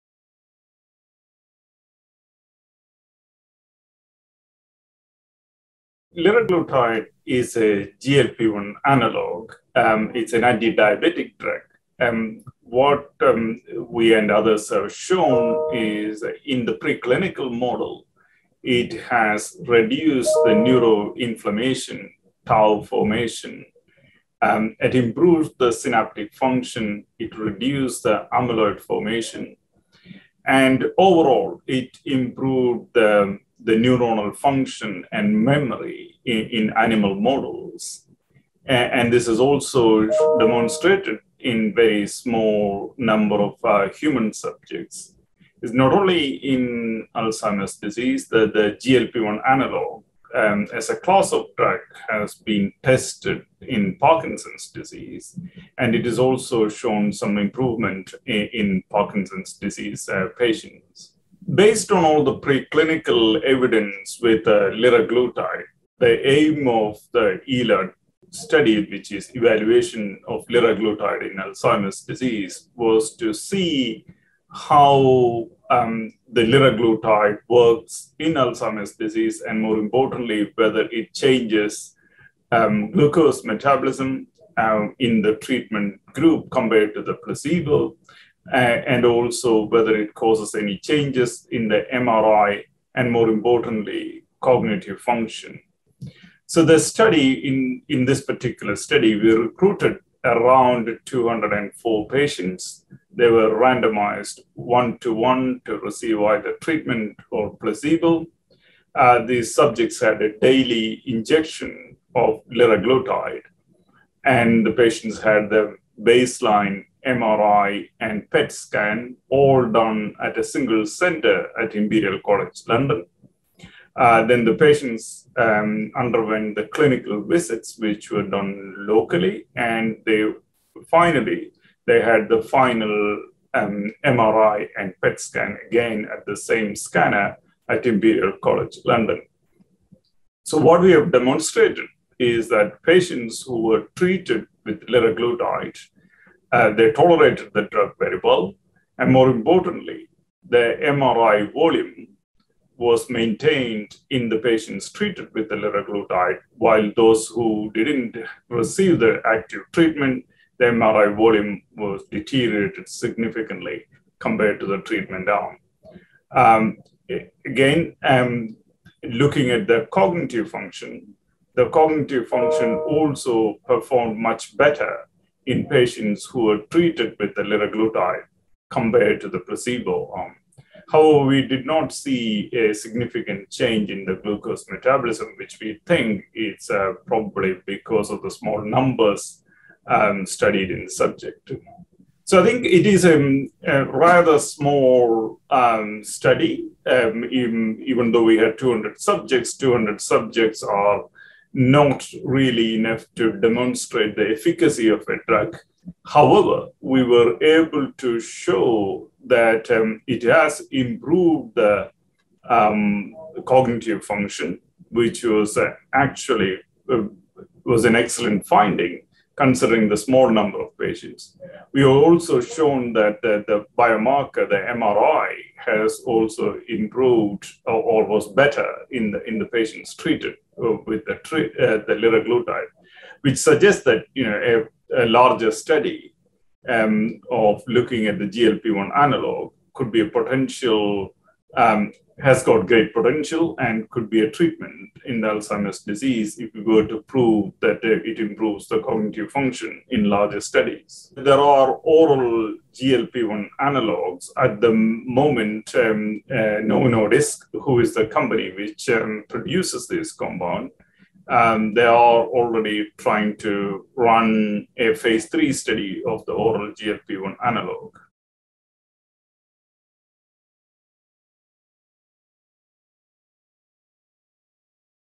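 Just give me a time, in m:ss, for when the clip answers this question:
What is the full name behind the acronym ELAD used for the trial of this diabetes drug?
1:09.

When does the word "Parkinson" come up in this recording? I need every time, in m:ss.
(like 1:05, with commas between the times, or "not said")
0:53, 0:58.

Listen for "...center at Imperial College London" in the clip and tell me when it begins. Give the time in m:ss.
2:00.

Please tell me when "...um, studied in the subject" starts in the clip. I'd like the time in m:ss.
3:09.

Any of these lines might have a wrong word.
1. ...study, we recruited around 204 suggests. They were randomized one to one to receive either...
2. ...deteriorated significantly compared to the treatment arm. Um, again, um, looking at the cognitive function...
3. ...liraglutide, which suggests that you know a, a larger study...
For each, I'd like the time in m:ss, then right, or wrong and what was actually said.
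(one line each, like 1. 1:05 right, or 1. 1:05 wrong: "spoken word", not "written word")
1. 1:38 wrong: "patients", not "suggests"
2. 2:42 right
3. 3:51 right.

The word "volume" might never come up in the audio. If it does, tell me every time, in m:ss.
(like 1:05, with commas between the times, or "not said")
2:31, 2:41.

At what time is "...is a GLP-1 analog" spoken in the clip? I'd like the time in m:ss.
0:07.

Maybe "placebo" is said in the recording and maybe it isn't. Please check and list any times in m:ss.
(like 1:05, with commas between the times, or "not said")
1:27, 1:47, 2:59.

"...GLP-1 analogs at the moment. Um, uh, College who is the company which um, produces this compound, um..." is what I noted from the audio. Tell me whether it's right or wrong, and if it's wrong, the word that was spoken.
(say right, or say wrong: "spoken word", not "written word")
wrong: "Novo", not "College".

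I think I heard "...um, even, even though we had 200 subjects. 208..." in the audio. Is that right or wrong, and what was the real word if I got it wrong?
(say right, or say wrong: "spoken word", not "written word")
wrong: "200", not "208".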